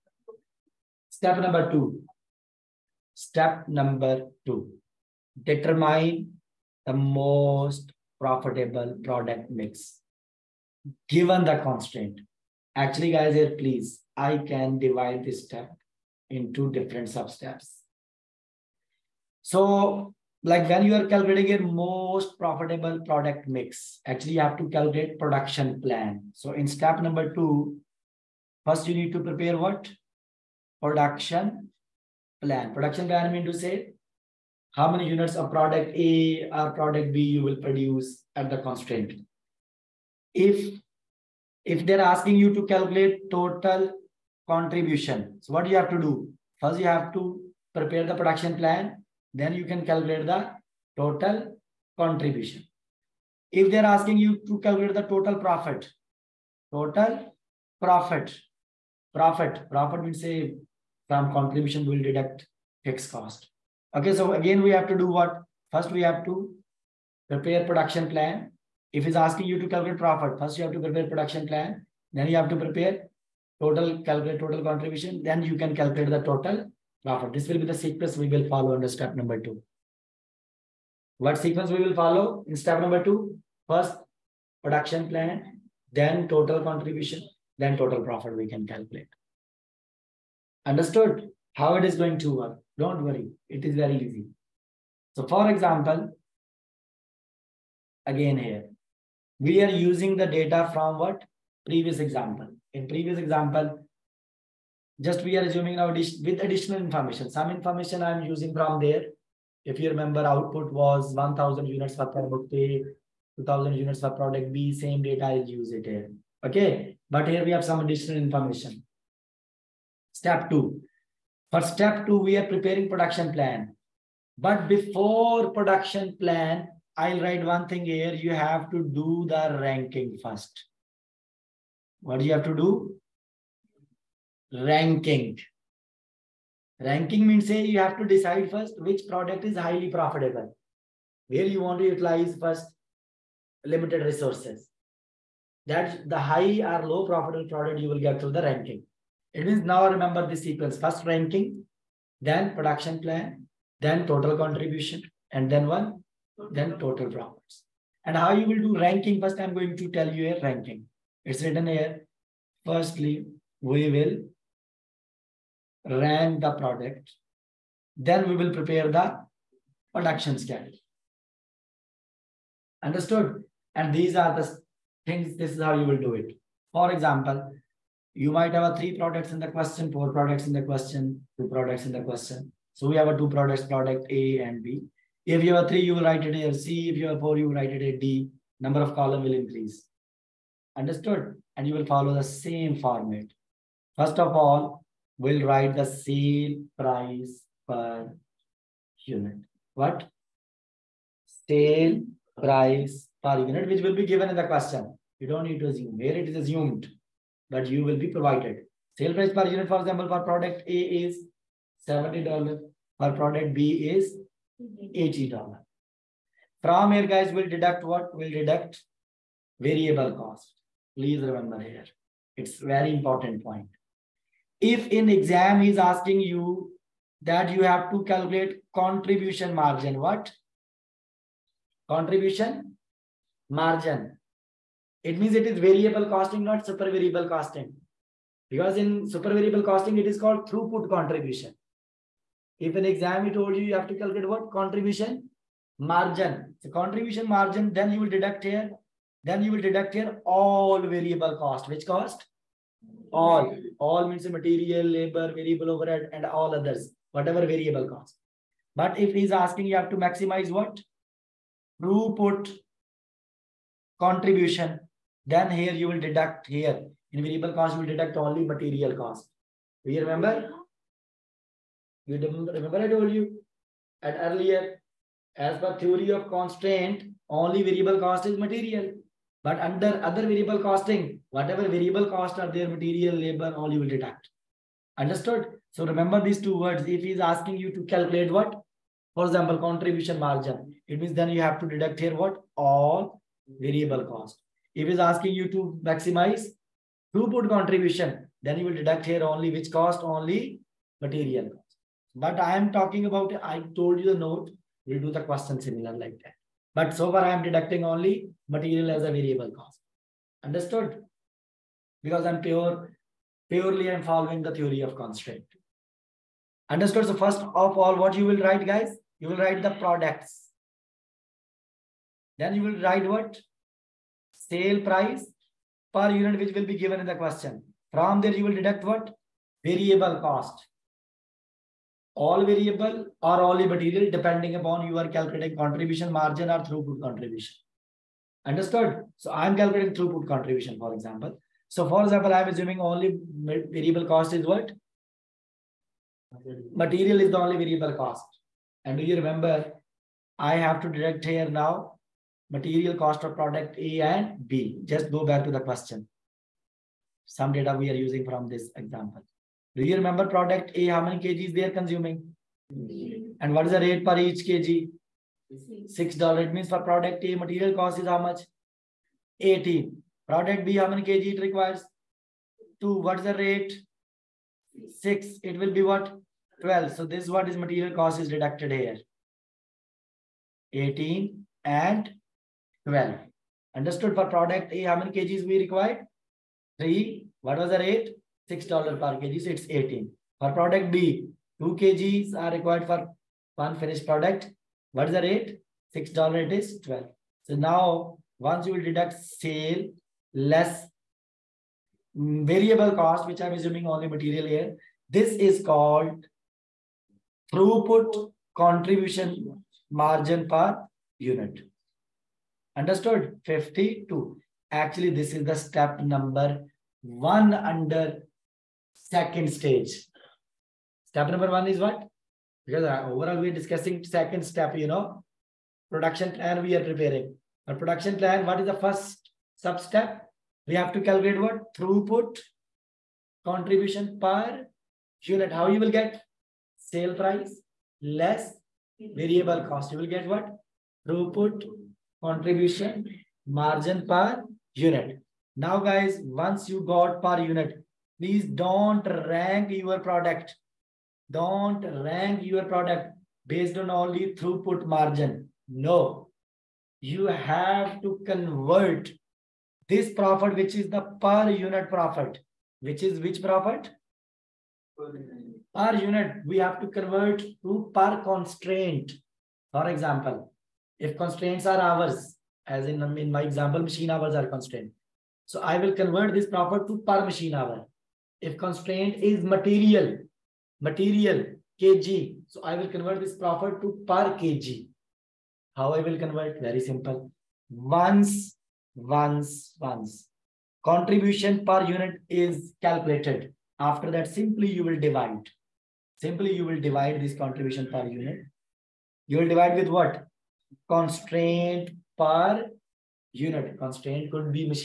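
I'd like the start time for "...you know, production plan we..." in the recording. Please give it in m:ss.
7:04.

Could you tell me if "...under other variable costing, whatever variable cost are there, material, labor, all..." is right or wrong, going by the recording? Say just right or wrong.
right.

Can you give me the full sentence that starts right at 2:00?
Step two, for step two, we are preparing production plan.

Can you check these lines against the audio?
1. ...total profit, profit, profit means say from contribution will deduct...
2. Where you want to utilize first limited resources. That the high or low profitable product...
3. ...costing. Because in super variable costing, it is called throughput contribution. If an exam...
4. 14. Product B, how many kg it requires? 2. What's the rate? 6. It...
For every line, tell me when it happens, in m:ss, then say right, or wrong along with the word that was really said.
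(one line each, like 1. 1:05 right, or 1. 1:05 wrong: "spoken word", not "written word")
1. 0:56 right
2. 2:21 right
3. 3:57 right
4. 6:09 wrong: "18", not "14".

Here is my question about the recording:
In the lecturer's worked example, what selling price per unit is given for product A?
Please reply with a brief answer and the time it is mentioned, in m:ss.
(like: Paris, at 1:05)
$70, at 3:31.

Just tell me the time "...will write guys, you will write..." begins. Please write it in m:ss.
5:18.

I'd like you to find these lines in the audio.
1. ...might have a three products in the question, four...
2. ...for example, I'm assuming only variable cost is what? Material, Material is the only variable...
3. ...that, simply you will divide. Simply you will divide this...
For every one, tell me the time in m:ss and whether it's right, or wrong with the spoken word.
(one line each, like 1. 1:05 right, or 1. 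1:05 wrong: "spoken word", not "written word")
1. 2:58 right
2. 5:41 right
3. 8:14 right.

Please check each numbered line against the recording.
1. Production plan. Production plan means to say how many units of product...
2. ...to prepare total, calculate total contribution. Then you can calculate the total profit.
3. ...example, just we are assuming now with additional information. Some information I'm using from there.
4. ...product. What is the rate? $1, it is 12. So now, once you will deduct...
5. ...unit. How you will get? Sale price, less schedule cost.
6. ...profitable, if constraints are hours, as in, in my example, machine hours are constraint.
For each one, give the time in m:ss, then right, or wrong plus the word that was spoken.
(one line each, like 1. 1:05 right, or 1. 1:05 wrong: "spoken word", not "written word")
1. 0:30 right
2. 1:12 right
3. 1:43 right
4. 6:34 wrong: "6", not "1"
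5. 7:15 wrong: "variable", not "schedule"
6. 7:49 wrong: "example", not "profitable".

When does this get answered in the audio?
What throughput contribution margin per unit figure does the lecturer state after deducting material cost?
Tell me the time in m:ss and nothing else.
6:53.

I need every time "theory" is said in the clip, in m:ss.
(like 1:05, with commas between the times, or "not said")
4:35, 5:14.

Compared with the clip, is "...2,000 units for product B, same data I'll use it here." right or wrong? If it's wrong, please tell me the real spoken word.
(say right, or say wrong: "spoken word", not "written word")
right.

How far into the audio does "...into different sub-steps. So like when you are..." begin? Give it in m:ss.
0:16.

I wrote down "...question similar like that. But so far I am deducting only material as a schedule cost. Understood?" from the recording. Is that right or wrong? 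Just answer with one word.
wrong.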